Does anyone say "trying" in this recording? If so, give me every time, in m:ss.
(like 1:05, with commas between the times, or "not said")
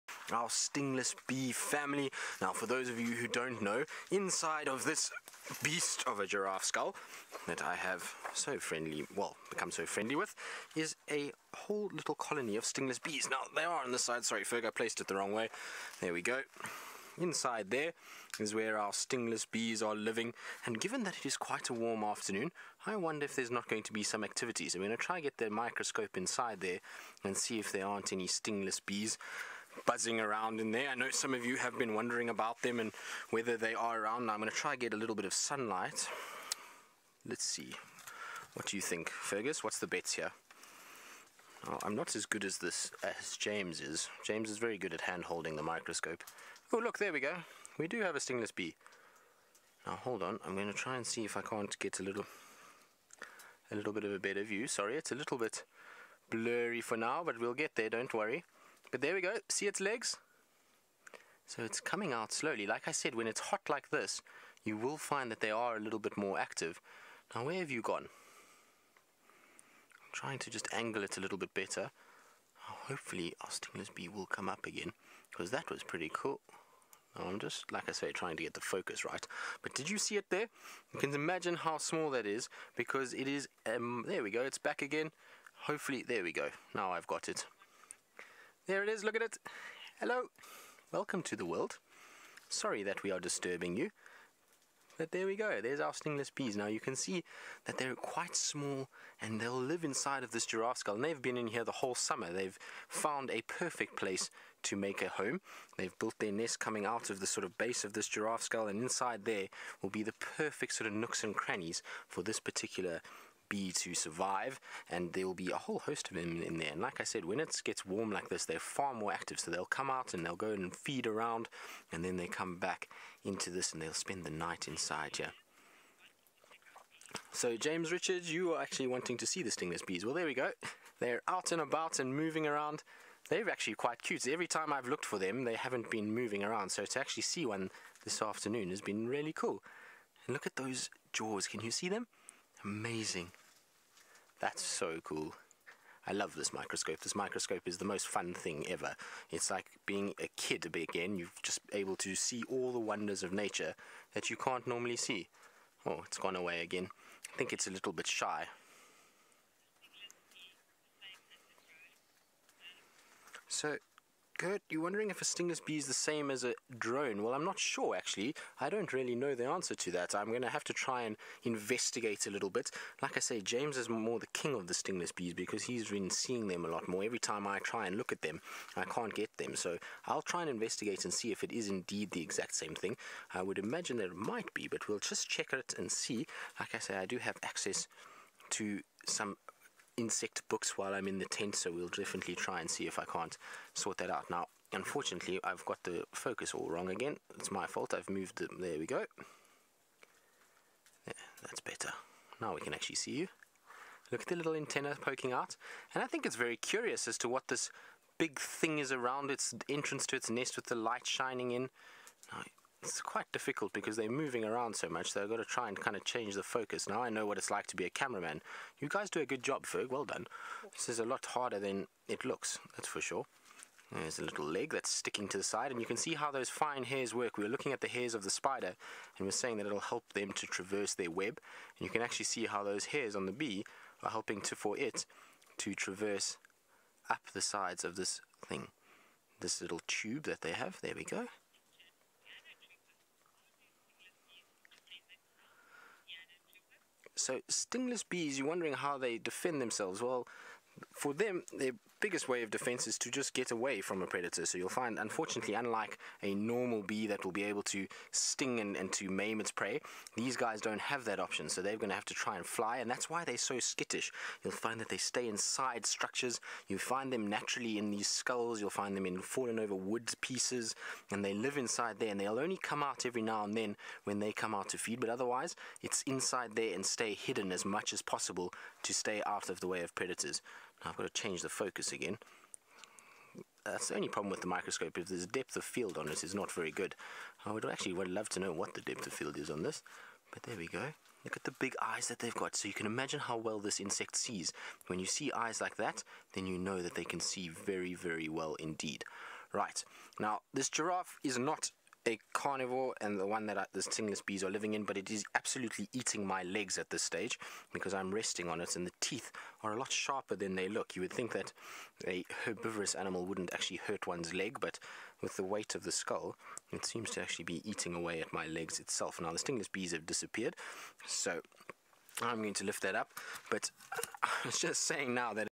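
1:10, 1:18.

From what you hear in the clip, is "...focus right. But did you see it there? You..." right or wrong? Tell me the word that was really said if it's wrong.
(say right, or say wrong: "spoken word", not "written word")
right.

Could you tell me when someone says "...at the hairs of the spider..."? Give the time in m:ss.
3:47.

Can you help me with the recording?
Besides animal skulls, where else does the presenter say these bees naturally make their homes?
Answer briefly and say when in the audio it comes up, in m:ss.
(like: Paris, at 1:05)
fallen over wood pieces, at 4:29.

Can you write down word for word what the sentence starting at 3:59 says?
This little tube that they have, there we go.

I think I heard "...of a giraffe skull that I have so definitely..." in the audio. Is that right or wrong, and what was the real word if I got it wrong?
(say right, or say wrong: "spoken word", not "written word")
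wrong: "friendly", not "definitely".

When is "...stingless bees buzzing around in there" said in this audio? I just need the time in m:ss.
0:28.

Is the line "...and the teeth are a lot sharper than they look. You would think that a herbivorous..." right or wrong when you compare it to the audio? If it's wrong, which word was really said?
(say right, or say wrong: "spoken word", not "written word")
right.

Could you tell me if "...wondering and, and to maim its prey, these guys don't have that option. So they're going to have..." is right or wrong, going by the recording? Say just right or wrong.
wrong.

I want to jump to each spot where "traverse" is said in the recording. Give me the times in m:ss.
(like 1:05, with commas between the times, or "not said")
3:50, 3:55.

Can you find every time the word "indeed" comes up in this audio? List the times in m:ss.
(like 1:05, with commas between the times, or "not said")
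3:01, 4:58.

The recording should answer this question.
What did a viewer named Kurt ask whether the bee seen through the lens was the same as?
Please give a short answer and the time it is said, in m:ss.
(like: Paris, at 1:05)
a drone, at 2:46.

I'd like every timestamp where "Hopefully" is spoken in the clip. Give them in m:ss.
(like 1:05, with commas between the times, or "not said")
1:12, 1:25.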